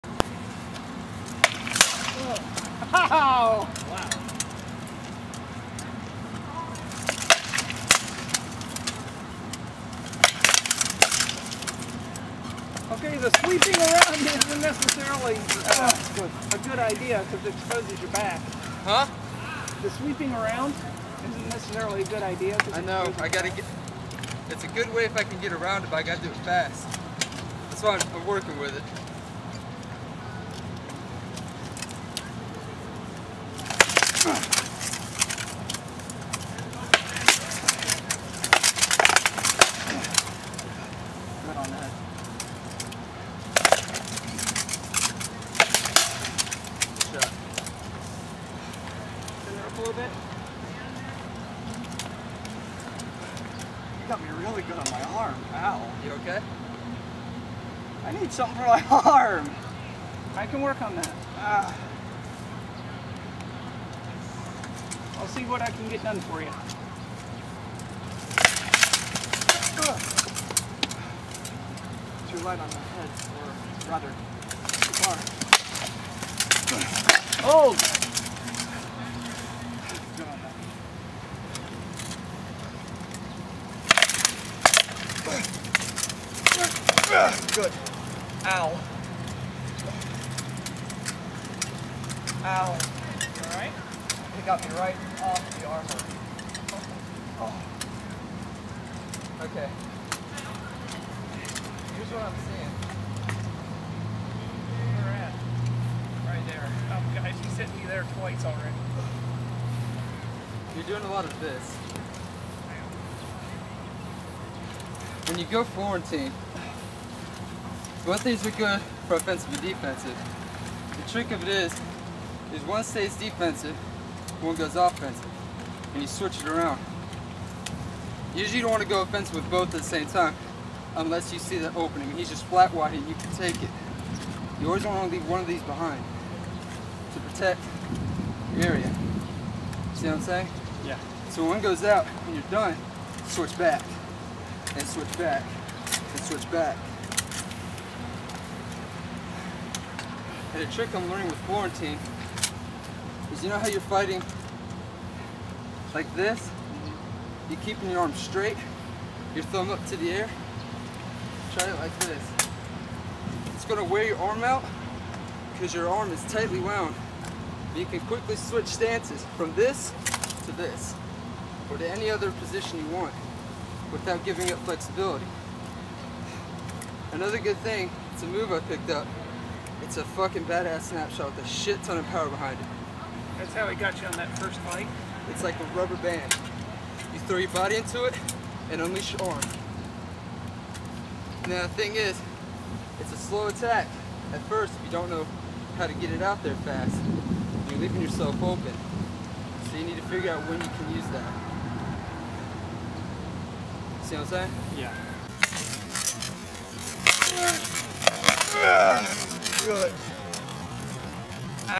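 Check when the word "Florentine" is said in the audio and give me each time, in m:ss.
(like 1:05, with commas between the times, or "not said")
1:55, 2:31.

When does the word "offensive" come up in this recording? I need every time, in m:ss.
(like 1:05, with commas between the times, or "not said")
1:59, 2:04, 2:09.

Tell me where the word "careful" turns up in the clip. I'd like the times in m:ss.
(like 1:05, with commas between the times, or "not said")
not said.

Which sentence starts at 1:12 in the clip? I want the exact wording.
It's light on my head, or rather, the bar.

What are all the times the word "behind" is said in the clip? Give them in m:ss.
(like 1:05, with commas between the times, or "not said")
2:15, 3:02.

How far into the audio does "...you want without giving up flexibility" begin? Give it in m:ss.
2:52.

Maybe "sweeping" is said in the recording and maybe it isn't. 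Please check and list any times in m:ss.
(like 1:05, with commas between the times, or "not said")
0:13, 0:19.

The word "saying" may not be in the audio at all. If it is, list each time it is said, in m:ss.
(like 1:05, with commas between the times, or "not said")
2:20, 3:29.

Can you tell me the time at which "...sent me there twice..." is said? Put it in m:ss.
1:47.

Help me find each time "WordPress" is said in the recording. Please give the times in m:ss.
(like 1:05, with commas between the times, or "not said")
not said.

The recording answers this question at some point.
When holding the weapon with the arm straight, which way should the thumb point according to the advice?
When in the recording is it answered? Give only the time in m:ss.
2:39.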